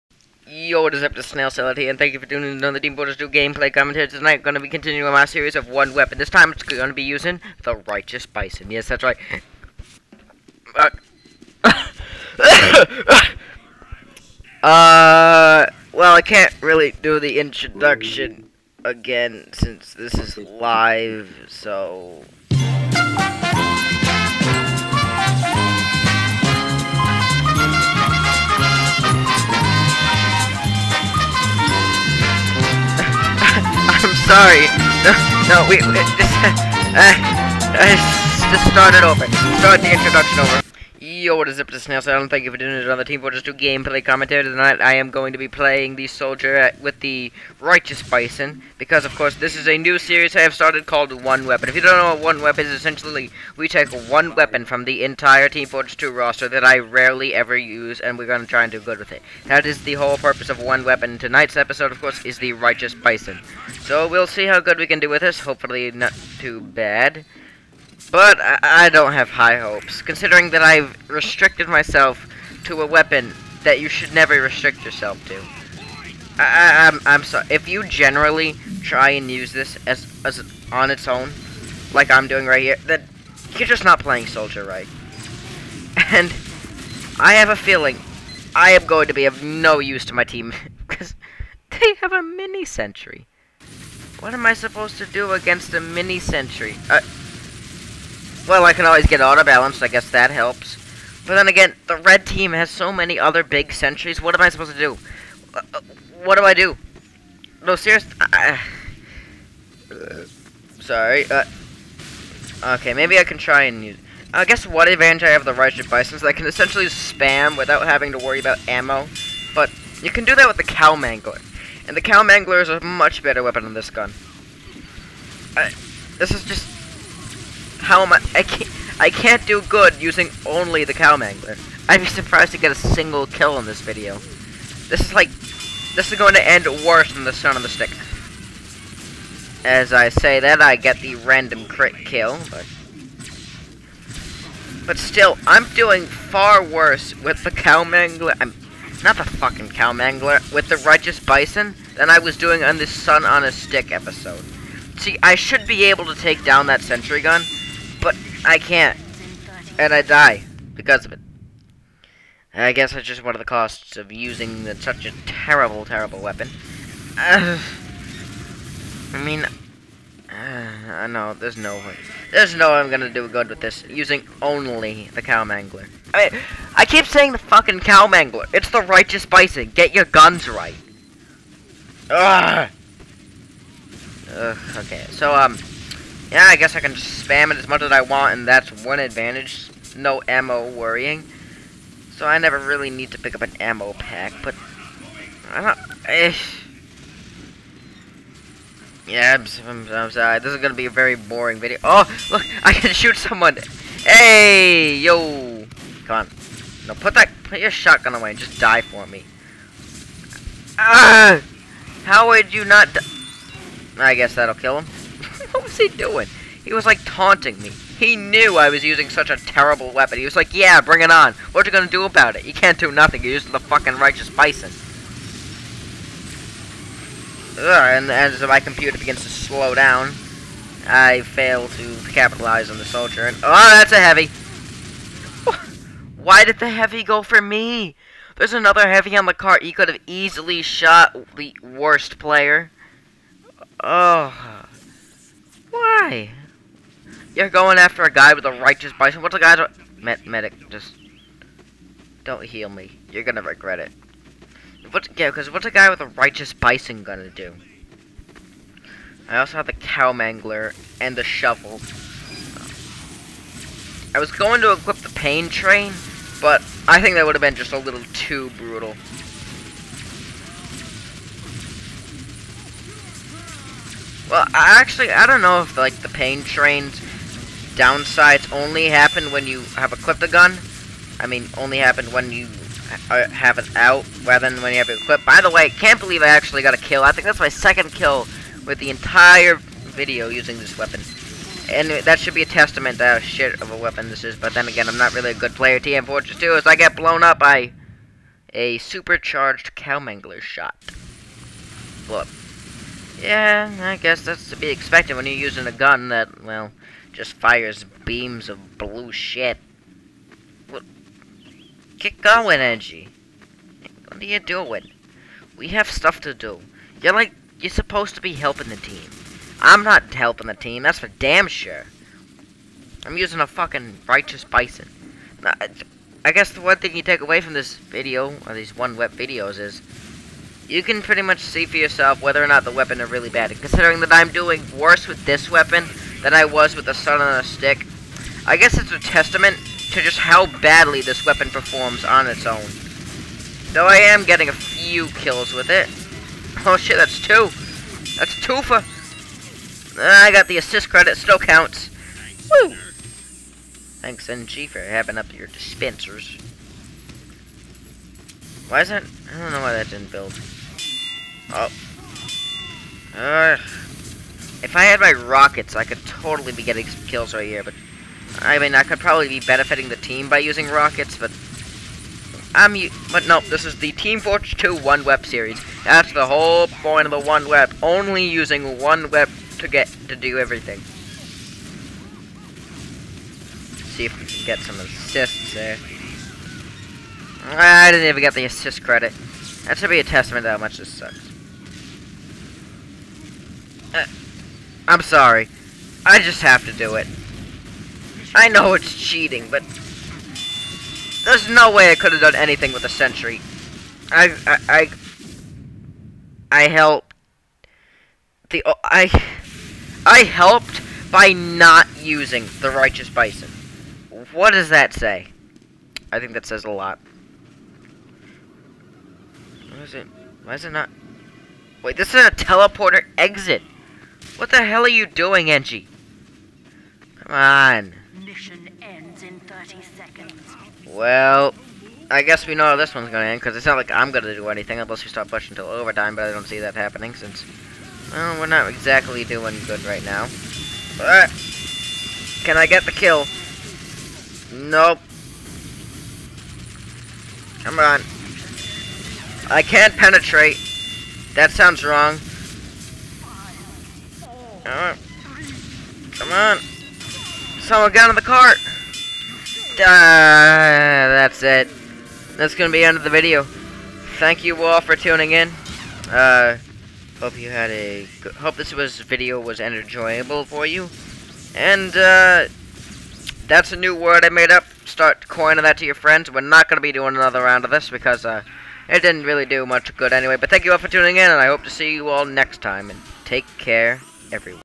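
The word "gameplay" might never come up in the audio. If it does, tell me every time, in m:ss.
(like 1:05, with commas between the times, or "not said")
0:03, 0:43.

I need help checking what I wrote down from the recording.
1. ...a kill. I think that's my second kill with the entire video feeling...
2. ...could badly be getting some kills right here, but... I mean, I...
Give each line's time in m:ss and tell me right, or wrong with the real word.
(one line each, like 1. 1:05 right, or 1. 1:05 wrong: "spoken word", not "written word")
1. 4:46 wrong: "using", not "feeling"
2. 6:05 wrong: "totally", not "badly".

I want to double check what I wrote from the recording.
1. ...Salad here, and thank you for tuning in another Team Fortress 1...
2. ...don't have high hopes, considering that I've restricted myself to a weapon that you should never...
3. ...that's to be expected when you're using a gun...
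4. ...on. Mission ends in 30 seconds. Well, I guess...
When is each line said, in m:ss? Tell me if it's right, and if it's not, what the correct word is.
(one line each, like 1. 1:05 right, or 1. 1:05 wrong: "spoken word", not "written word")
1. 0:01 wrong: "2", not "1"
2. 1:08 right
3. 5:04 right
4. 7:07 right.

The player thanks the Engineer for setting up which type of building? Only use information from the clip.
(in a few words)
dispensers.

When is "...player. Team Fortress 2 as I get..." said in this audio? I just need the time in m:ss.
4:55.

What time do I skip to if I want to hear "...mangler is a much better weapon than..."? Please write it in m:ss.
2:02.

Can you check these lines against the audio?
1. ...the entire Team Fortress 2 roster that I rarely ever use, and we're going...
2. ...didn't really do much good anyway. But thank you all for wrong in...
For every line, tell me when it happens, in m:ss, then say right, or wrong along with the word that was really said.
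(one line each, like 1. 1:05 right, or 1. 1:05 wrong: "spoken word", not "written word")
1. 0:54 right
2. 7:59 wrong: "tuning", not "wrong".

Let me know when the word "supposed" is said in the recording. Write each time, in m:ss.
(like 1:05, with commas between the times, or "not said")
1:34, 1:44, 5:17.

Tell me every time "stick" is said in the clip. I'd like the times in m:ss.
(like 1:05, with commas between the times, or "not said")
2:17, 2:33, 5:37.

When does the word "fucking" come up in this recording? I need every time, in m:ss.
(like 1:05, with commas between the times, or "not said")
2:29, 2:57, 3:43, 5:23.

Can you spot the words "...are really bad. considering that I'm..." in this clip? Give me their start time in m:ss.
5:33.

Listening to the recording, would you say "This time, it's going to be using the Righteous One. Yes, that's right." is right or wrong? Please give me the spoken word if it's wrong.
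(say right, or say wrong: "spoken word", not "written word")
wrong: "Bison", not "One".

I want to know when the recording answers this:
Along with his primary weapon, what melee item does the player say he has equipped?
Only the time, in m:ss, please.
4:21.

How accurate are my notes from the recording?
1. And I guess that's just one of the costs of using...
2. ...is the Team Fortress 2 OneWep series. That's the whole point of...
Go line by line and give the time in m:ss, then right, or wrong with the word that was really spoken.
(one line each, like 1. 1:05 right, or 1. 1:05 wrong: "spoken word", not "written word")
1. 2:42 right
2. 6:13 right.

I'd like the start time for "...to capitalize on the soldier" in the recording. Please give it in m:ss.
3:51.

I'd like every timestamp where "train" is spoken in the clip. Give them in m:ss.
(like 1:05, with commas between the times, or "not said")
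4:25, 4:36.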